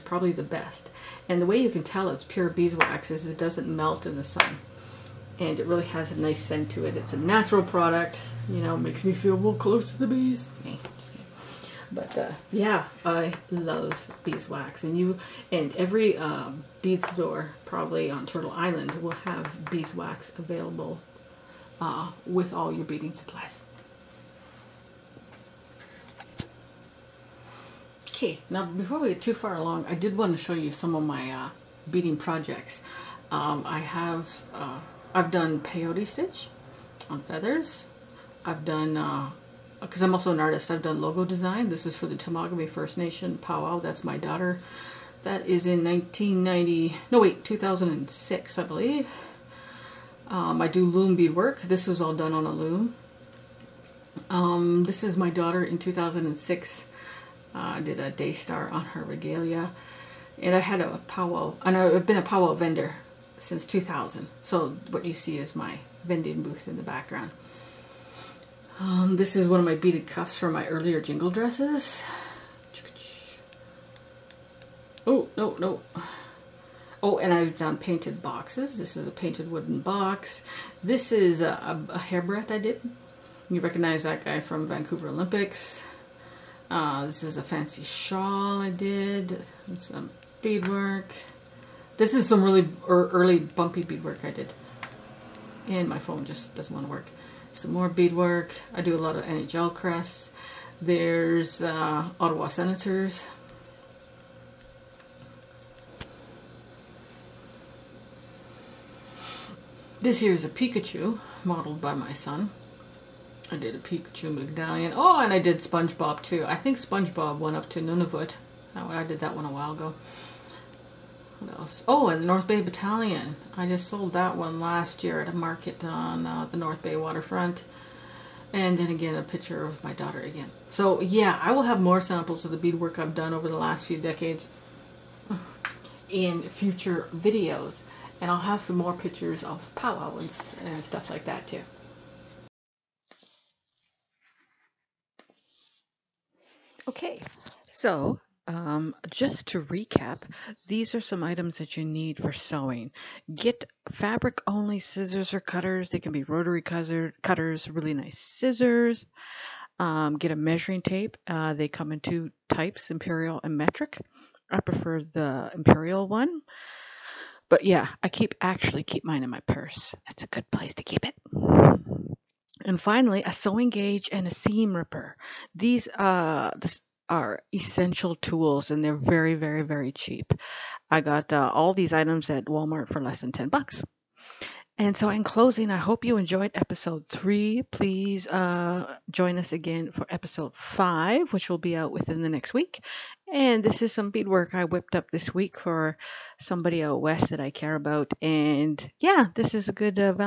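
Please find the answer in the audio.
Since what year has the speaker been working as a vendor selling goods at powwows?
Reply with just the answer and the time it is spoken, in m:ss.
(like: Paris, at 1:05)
2000, at 1:03.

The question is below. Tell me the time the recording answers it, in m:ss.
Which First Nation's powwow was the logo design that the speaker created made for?
0:42.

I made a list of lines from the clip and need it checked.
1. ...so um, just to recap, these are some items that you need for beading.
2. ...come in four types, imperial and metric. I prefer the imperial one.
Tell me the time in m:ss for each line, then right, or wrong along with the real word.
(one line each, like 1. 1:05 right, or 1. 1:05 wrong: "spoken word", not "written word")
1. 2:27 wrong: "sewing", not "beading"
2. 2:41 wrong: "two", not "four".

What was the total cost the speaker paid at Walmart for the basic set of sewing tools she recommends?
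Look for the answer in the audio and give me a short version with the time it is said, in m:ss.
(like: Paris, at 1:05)
less than $10, at 3:03.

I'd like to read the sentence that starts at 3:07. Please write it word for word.
Please uh, join us again for episode five, which will be out within the next week.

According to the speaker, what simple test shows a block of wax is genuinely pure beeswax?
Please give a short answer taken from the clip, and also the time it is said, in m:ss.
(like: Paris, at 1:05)
doesn't melt in the sun, at 0:03.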